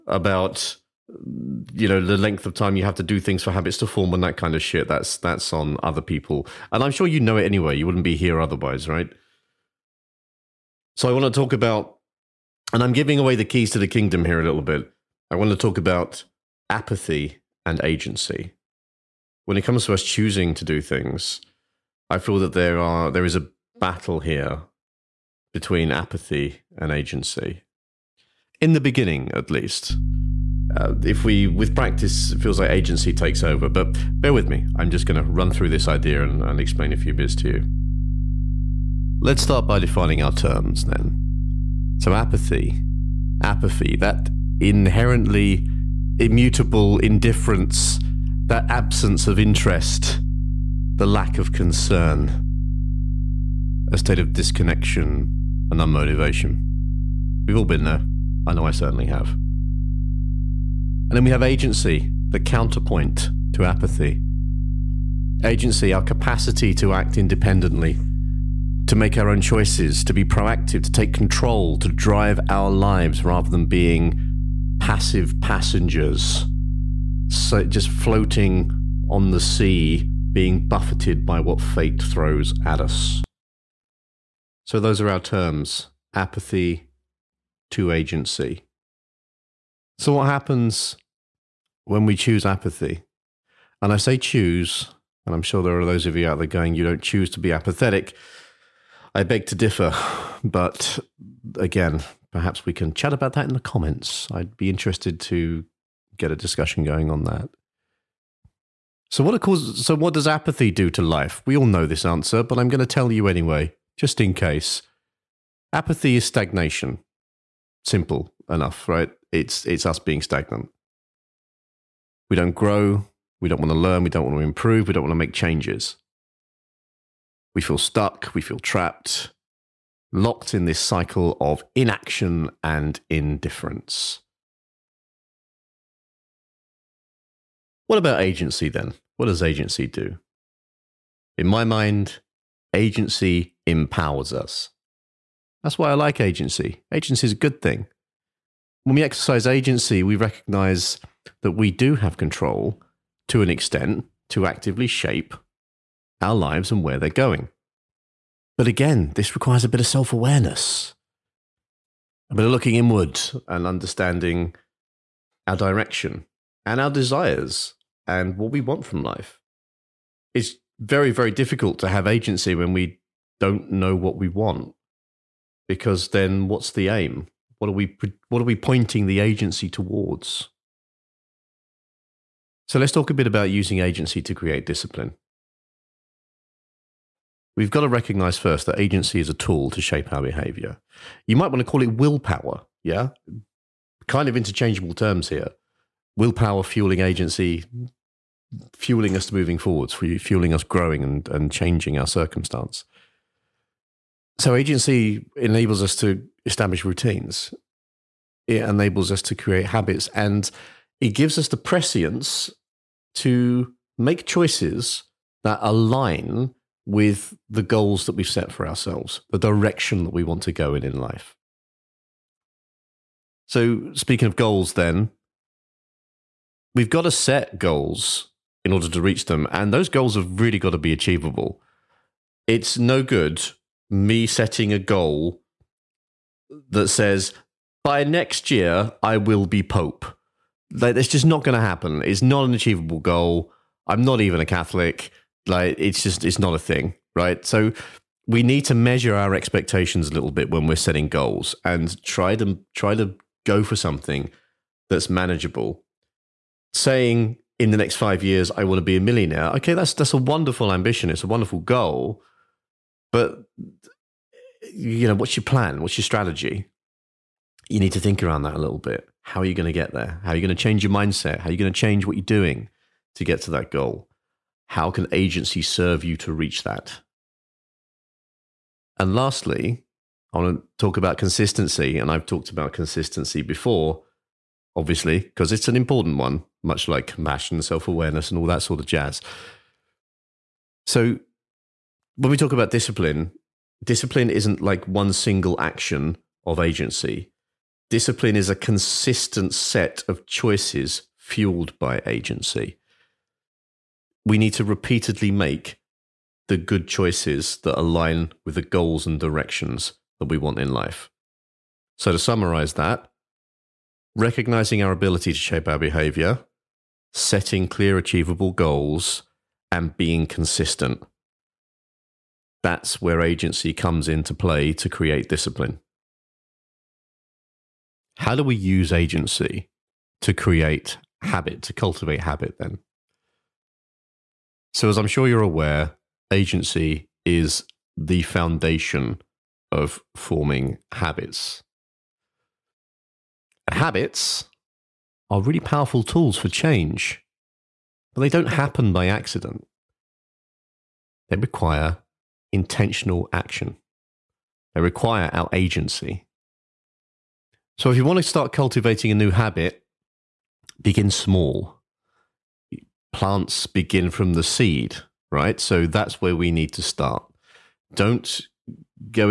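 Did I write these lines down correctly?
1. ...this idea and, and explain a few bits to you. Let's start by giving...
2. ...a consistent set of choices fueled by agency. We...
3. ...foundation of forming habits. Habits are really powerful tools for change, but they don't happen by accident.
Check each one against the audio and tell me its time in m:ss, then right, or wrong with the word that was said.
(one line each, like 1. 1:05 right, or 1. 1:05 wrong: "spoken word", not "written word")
1. 0:35 wrong: "defining", not "giving"
2. 4:58 right
3. 5:38 right.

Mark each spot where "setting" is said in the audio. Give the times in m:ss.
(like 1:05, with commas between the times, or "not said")
3:54, 4:10, 5:17.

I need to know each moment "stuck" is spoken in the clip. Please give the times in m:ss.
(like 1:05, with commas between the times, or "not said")
2:07.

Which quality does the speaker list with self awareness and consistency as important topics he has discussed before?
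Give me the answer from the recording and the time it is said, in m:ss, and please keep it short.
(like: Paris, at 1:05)
Compassion, at 4:47.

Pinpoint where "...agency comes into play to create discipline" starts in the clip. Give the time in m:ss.
5:23.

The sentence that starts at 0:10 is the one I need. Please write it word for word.
So I want to talk about, and I'm giving away the keys to the kingdom here a little bit.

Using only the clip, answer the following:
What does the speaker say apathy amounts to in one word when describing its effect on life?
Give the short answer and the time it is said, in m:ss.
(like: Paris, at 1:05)
Stagnation, at 1:56.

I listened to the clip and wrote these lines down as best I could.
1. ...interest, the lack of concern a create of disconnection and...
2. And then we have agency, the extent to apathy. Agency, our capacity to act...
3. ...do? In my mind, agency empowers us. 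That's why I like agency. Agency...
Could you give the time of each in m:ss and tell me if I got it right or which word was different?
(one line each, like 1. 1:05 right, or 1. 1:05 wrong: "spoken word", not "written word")
1. 0:49 wrong: "state", not "create"
2. 1:01 wrong: "counterpoint", not "extent"
3. 2:19 right.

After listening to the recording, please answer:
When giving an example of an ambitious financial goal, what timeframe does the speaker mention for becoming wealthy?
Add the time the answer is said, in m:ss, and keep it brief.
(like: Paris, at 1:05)
5 years, at 4:17.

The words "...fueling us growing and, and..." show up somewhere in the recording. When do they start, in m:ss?
3:19.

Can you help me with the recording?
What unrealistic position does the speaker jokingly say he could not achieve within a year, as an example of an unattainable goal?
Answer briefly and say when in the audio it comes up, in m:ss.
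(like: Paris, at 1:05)
Pope, at 3:59.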